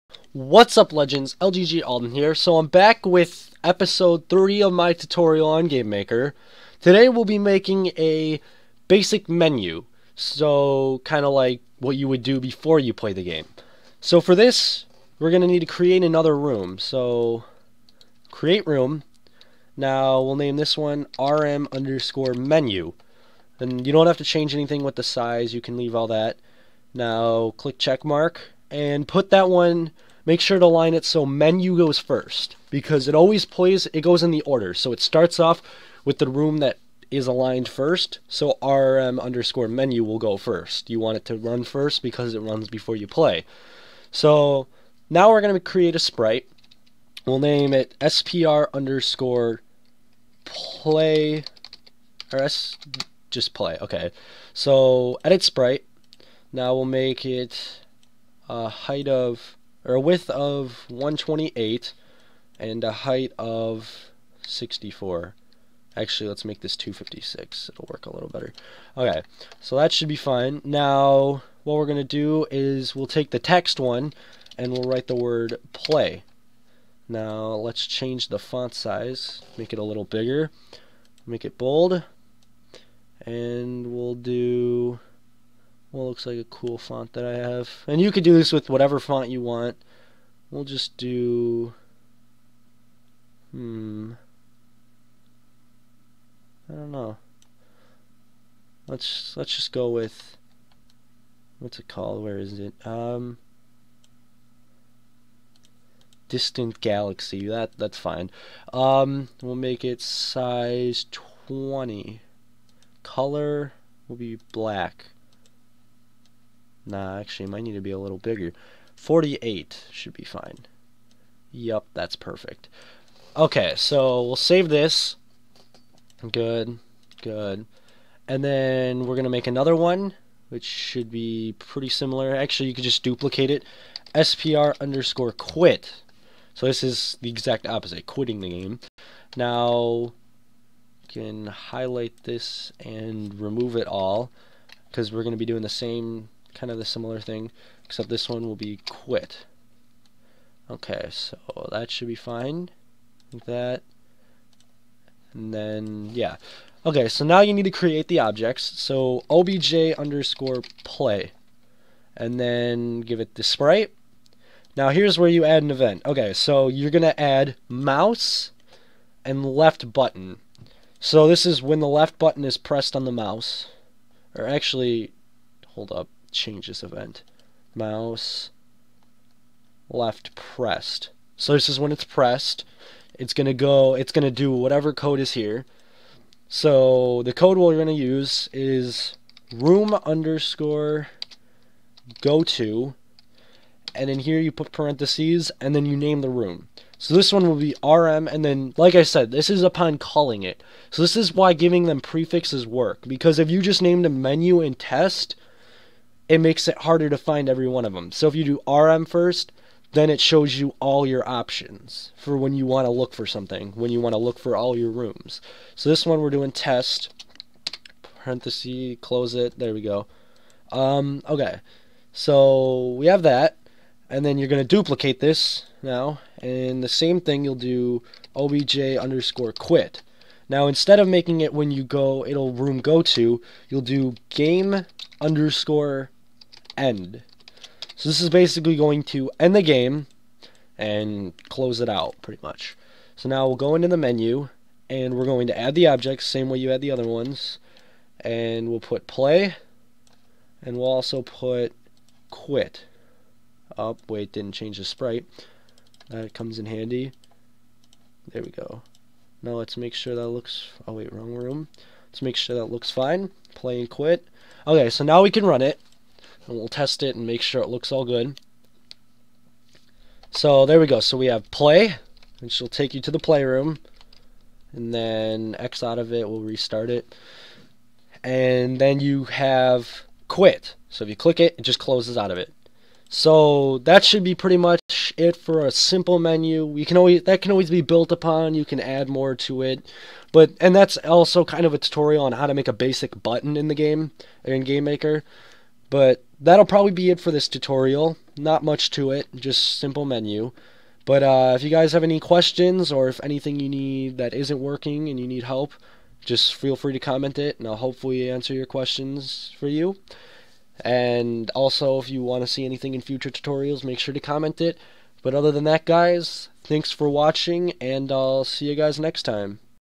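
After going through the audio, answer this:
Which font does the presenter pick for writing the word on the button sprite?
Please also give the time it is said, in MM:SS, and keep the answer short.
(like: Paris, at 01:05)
Distant Galaxy, at 01:46.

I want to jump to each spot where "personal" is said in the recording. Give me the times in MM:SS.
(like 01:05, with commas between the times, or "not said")
not said.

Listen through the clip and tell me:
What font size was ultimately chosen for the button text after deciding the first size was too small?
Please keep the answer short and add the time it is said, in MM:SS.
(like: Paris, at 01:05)
48, at 01:58.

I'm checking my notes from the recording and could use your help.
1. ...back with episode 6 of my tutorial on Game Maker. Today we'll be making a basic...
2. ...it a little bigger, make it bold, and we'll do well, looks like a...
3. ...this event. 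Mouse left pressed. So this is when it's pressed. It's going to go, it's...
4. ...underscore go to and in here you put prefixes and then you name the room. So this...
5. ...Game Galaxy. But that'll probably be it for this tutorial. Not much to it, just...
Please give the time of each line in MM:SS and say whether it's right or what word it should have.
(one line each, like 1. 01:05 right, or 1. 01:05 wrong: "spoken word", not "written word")
1. 00:02 wrong: "3", not "6"
2. 01:19 right
3. 02:56 right
4. 03:10 wrong: "parentheses", not "prefixes"
5. 04:54 wrong: "Maker", not "Galaxy".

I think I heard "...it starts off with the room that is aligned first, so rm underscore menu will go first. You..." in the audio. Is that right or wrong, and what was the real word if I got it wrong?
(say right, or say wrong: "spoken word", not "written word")
right.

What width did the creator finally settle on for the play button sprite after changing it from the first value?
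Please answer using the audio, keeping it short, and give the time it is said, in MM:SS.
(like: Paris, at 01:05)
256, at 01:06.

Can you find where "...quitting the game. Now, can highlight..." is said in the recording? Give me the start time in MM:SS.
02:18.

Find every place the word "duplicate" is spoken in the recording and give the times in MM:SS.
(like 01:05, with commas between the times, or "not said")
02:13, 03:44.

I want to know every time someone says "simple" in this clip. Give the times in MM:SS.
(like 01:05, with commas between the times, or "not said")
04:45, 04:59.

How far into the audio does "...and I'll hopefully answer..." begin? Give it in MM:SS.
05:07.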